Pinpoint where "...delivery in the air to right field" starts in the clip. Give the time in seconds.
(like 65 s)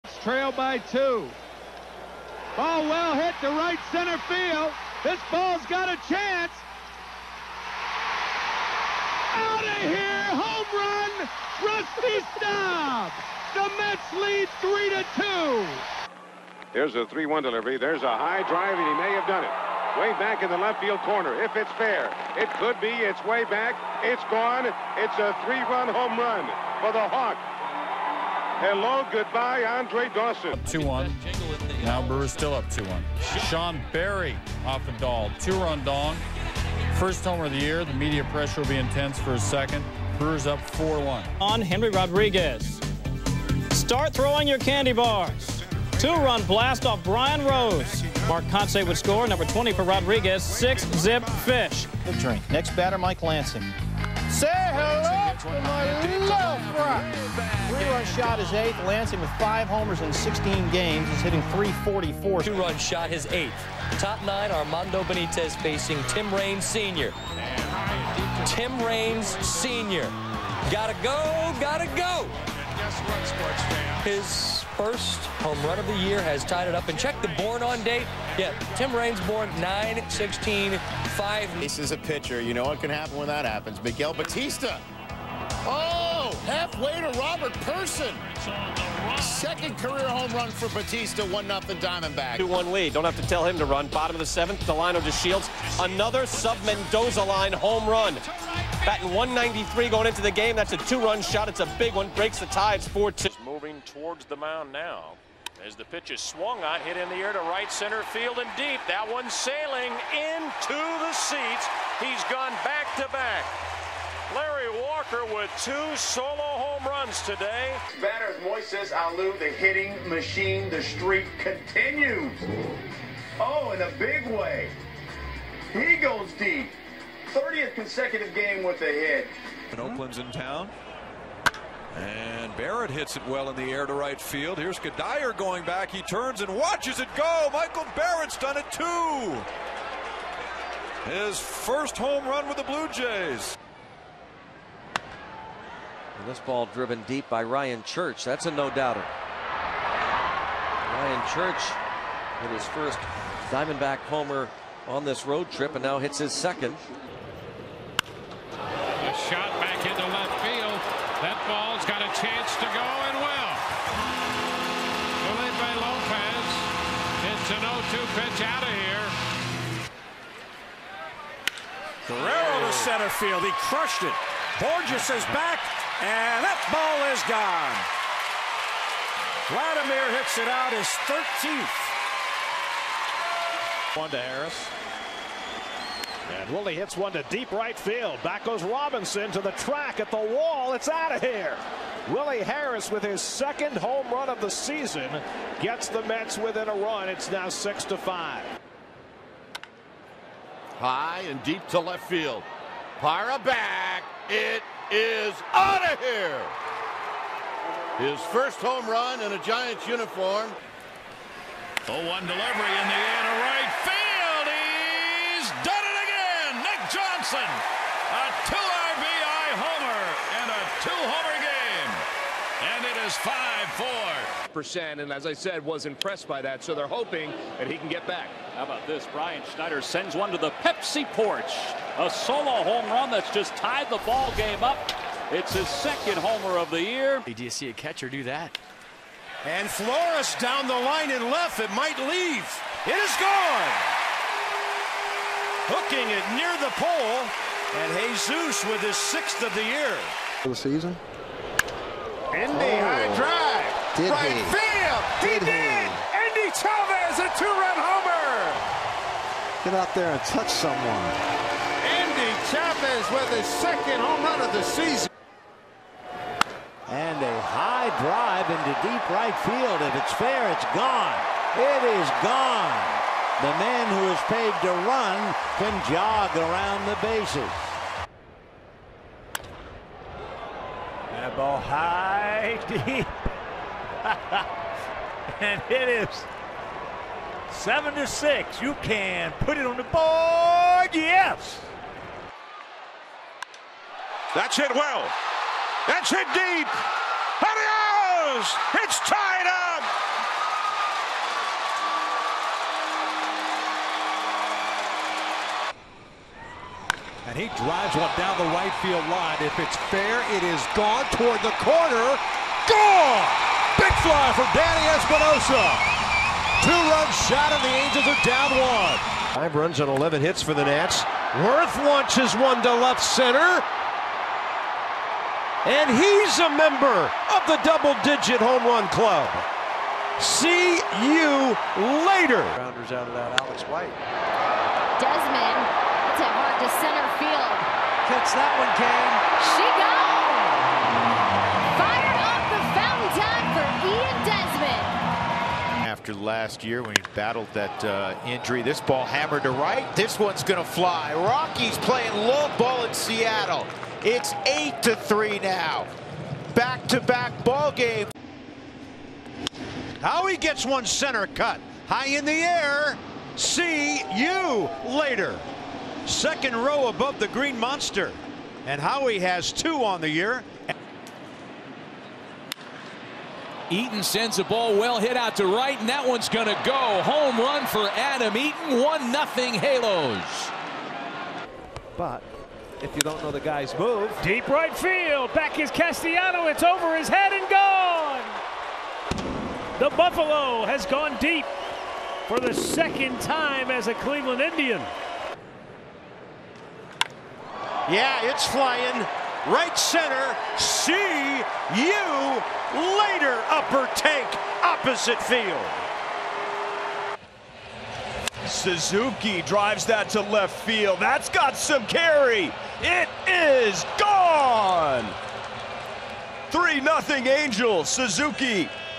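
212 s.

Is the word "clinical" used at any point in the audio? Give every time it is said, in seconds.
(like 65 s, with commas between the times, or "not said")
not said.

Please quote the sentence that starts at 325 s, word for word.
And he's a member of the double-digit home run club.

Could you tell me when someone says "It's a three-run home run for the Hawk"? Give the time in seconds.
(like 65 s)
24 s.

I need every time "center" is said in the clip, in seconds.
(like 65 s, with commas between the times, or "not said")
3 s, 107 s, 172 s, 323 s, 336 s, 360 s, 399 s.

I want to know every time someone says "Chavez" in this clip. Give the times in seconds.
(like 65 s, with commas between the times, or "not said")
256 s, 262 s.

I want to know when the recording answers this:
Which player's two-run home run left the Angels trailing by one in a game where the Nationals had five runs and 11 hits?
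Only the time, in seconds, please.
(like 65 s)
314 s.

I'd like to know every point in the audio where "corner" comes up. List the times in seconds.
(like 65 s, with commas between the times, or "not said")
21 s, 311 s.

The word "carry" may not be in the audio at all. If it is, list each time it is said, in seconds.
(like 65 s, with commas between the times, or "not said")
411 s.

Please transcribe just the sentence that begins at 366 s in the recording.
Second row above the green monster.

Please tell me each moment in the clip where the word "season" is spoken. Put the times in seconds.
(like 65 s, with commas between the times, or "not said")
194 s, 250 s, 264 s.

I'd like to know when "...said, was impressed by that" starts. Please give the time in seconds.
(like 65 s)
225 s.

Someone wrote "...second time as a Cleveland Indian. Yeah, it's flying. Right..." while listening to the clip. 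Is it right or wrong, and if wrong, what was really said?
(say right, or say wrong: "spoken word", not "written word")
right.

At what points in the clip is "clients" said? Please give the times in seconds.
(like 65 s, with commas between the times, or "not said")
not said.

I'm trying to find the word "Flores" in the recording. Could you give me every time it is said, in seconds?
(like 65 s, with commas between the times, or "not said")
239 s.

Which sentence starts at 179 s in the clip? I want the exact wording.
Vladimir hits it out his 13th.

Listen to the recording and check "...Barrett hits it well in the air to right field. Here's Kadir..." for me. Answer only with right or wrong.
right.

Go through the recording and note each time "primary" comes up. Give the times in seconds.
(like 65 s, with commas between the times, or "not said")
not said.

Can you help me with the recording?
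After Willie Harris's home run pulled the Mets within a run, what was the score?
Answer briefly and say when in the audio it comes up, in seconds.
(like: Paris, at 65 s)
6 to 5, at 197 s.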